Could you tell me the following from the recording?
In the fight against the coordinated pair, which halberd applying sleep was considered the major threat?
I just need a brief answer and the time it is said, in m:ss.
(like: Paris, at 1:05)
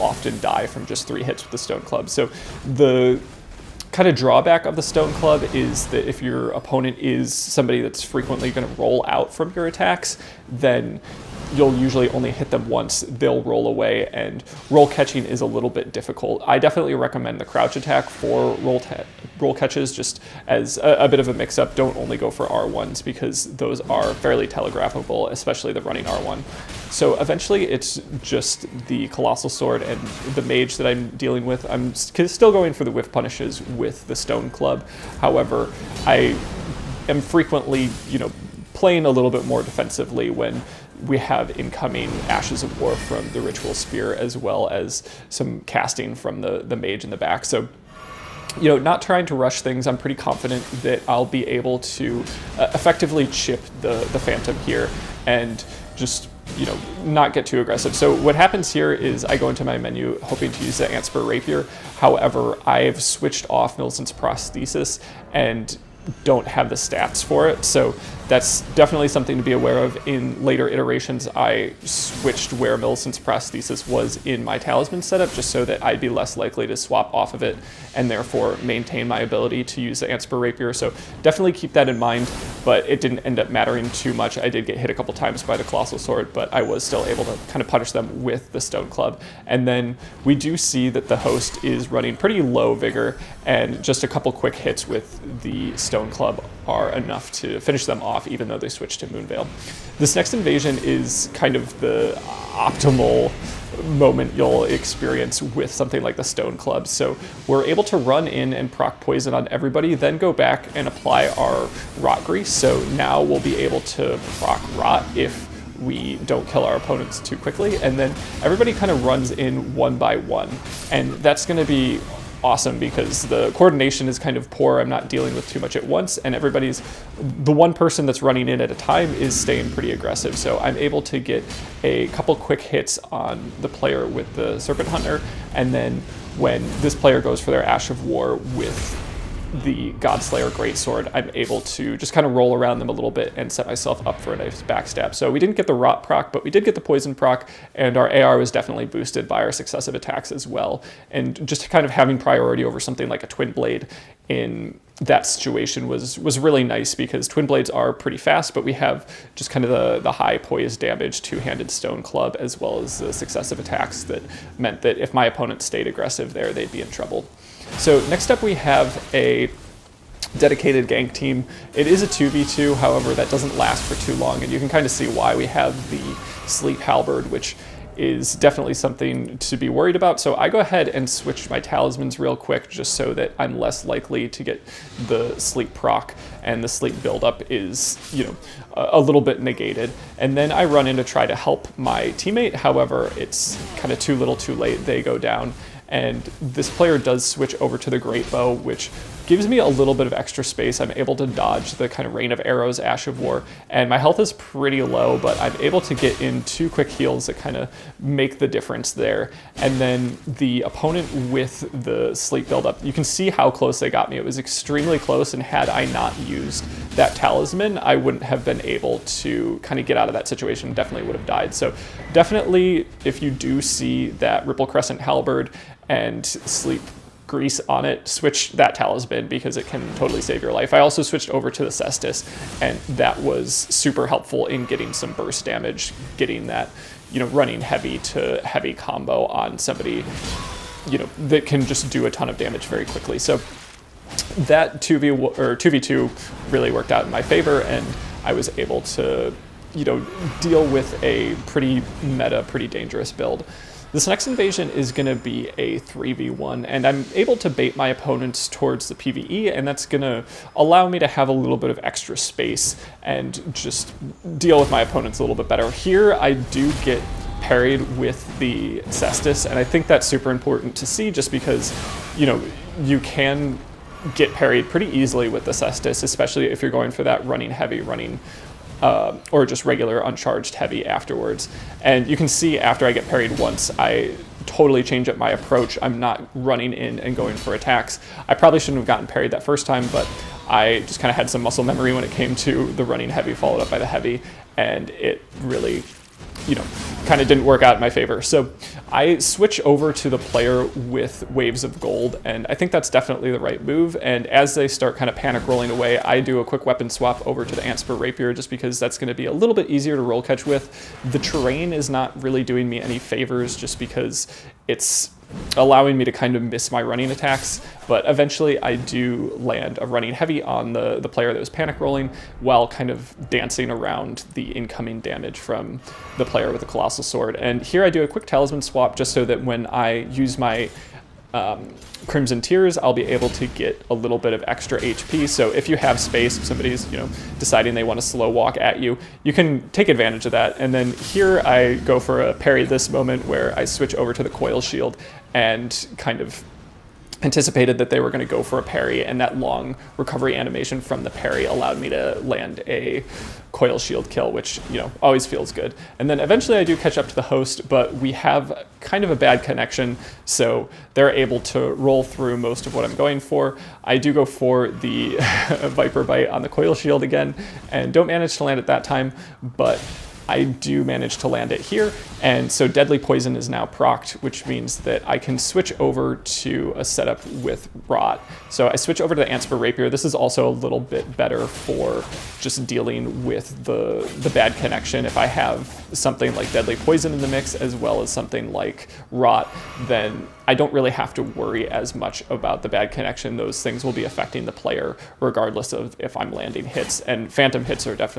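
Ripple Crescent Halberd, at 3:44.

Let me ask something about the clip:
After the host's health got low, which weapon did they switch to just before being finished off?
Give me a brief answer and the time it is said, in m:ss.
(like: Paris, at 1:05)
Moonveil, at 1:39.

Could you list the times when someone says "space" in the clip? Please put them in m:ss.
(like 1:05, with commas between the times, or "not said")
3:20, 4:22, 5:35.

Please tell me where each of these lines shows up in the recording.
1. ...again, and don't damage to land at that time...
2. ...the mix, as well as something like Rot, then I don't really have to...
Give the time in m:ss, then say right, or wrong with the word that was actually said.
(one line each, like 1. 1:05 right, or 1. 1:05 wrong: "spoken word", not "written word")
1. 6:07 wrong: "manage", not "damage"
2. 6:27 right.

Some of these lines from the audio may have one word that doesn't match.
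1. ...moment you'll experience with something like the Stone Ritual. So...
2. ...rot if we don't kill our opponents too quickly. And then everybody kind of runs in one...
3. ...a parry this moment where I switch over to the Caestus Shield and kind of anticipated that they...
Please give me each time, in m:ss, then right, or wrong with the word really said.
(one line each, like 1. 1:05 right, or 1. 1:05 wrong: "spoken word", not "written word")
1. 1:43 wrong: "Club", not "Ritual"
2. 1:54 right
3. 5:42 wrong: "Coil", not "Caestus".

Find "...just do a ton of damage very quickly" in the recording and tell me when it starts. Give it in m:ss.
4:01.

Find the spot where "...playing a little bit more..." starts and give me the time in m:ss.
0:38.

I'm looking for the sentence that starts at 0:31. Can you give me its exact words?
I'm still going for the whiff punishes with the Stone Club.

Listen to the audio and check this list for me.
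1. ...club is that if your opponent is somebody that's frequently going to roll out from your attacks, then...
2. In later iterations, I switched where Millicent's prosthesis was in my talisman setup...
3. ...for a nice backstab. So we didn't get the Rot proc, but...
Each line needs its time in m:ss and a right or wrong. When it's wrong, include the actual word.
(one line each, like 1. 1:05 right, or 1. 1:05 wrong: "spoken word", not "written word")
1. 0:05 right
2. 1:10 right
3. 2:24 right.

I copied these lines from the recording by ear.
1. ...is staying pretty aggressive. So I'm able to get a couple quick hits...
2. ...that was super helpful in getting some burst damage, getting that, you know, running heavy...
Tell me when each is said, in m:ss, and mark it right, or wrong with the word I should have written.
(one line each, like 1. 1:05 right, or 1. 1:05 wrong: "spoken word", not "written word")
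1. 2:09 right
2. 3:52 right.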